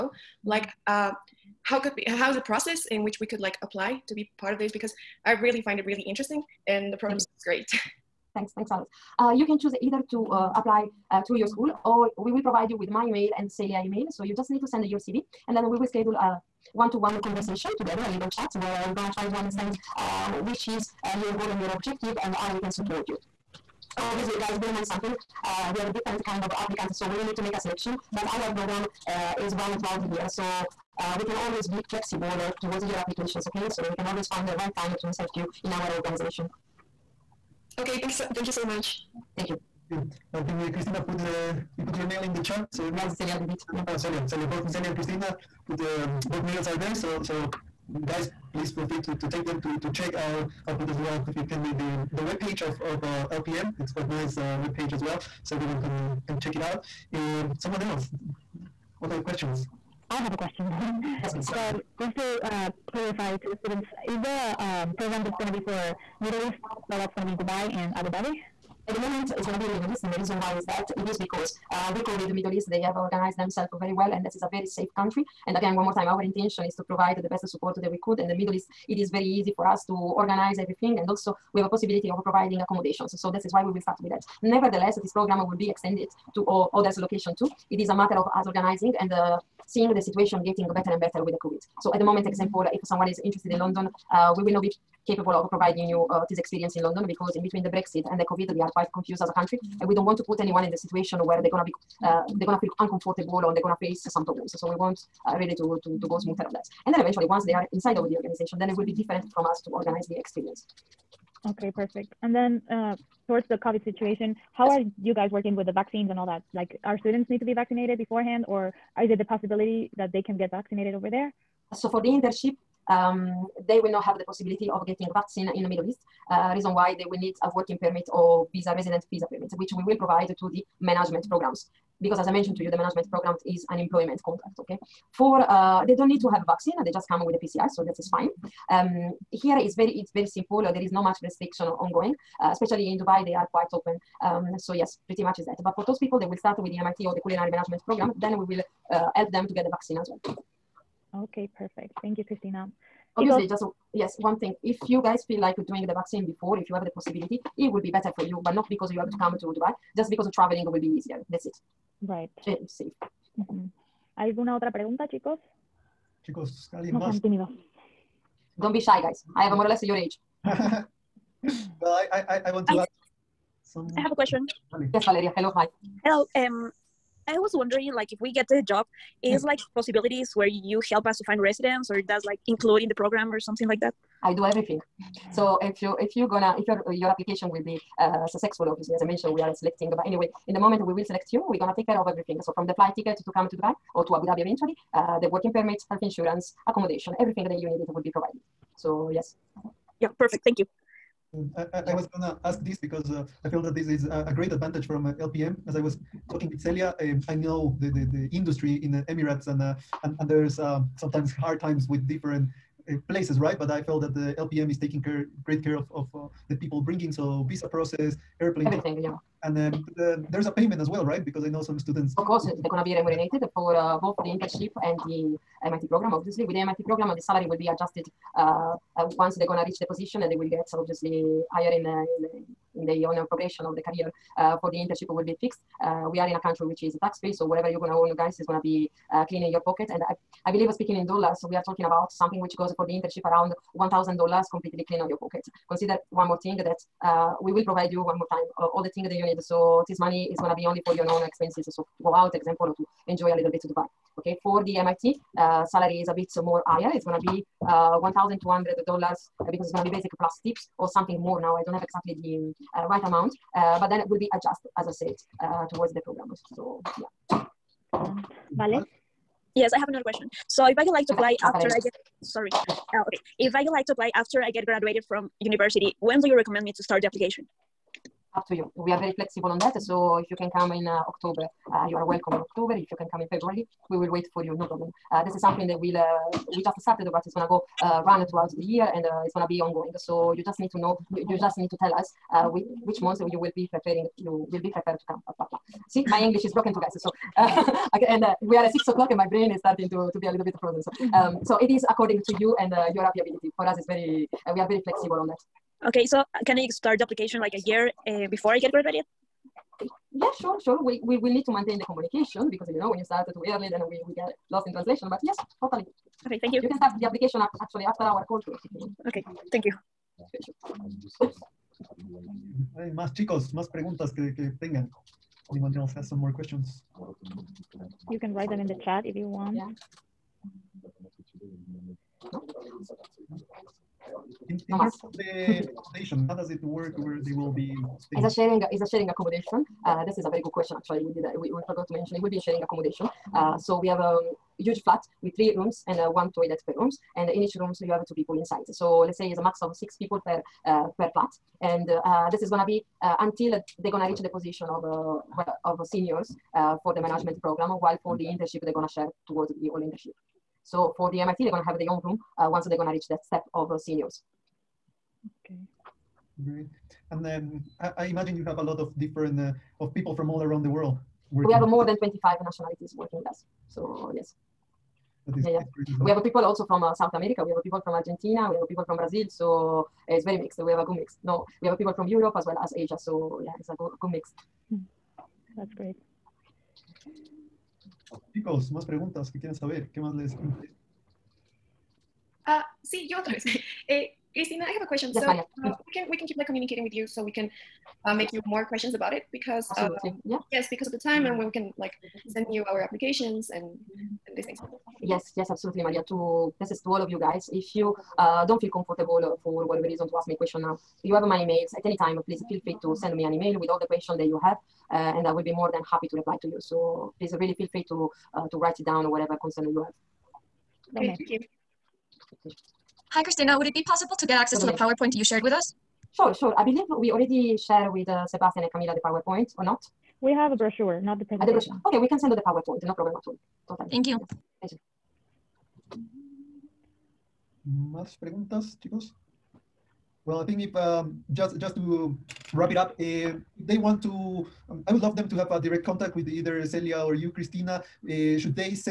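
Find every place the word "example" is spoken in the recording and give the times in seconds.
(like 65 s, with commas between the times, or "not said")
92 s, 252 s.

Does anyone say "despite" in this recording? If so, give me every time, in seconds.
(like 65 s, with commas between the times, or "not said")
not said.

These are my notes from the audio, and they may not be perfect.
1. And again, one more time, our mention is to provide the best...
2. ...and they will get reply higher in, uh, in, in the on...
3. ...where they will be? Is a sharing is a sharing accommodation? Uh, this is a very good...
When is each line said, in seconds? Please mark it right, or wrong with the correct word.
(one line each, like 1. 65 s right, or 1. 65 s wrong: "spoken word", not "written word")
1. 75 s wrong: "intention", not "mention"
2. 230 s wrong: "obviously", not "reply"
3. 336 s right.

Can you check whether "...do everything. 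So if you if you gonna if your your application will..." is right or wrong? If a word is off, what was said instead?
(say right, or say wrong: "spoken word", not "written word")
right.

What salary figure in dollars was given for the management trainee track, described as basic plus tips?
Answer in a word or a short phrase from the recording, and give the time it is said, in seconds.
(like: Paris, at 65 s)
$1,200, at 258 s.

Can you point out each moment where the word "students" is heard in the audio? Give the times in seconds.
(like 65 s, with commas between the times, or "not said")
63 s, 117 s, 221 s.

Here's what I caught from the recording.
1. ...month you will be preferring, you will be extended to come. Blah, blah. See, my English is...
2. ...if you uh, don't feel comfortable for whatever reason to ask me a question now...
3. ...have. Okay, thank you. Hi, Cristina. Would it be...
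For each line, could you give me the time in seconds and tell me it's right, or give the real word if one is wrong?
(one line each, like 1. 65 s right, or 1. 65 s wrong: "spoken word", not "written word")
1. 293 s wrong: "prepared", not "extended"
2. 407 s right
3. 419 s right.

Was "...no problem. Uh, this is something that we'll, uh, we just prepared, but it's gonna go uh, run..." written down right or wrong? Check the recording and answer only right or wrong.
wrong.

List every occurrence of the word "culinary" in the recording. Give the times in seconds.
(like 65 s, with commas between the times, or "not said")
147 s.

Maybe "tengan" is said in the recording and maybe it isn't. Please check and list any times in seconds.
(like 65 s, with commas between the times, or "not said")
324 s.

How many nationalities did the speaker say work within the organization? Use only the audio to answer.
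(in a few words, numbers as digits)
More than 25.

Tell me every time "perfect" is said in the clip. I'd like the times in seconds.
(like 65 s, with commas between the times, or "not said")
111 s, 151 s, 200 s.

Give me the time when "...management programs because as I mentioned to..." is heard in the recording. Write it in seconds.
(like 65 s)
130 s.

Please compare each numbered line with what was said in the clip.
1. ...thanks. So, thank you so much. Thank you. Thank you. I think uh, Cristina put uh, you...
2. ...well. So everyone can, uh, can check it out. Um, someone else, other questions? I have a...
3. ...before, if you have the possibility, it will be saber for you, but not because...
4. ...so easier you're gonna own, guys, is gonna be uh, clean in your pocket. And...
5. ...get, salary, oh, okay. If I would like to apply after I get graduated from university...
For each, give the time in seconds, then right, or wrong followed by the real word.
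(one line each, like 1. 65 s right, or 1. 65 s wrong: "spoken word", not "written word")
1. 38 s right
2. 55 s right
3. 156 s wrong: "better", not "saber"
4. 237 s wrong: "whatever", not "easier"
5. 271 s wrong: "sorry", not "salary".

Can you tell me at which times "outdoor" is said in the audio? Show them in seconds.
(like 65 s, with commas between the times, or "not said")
not said.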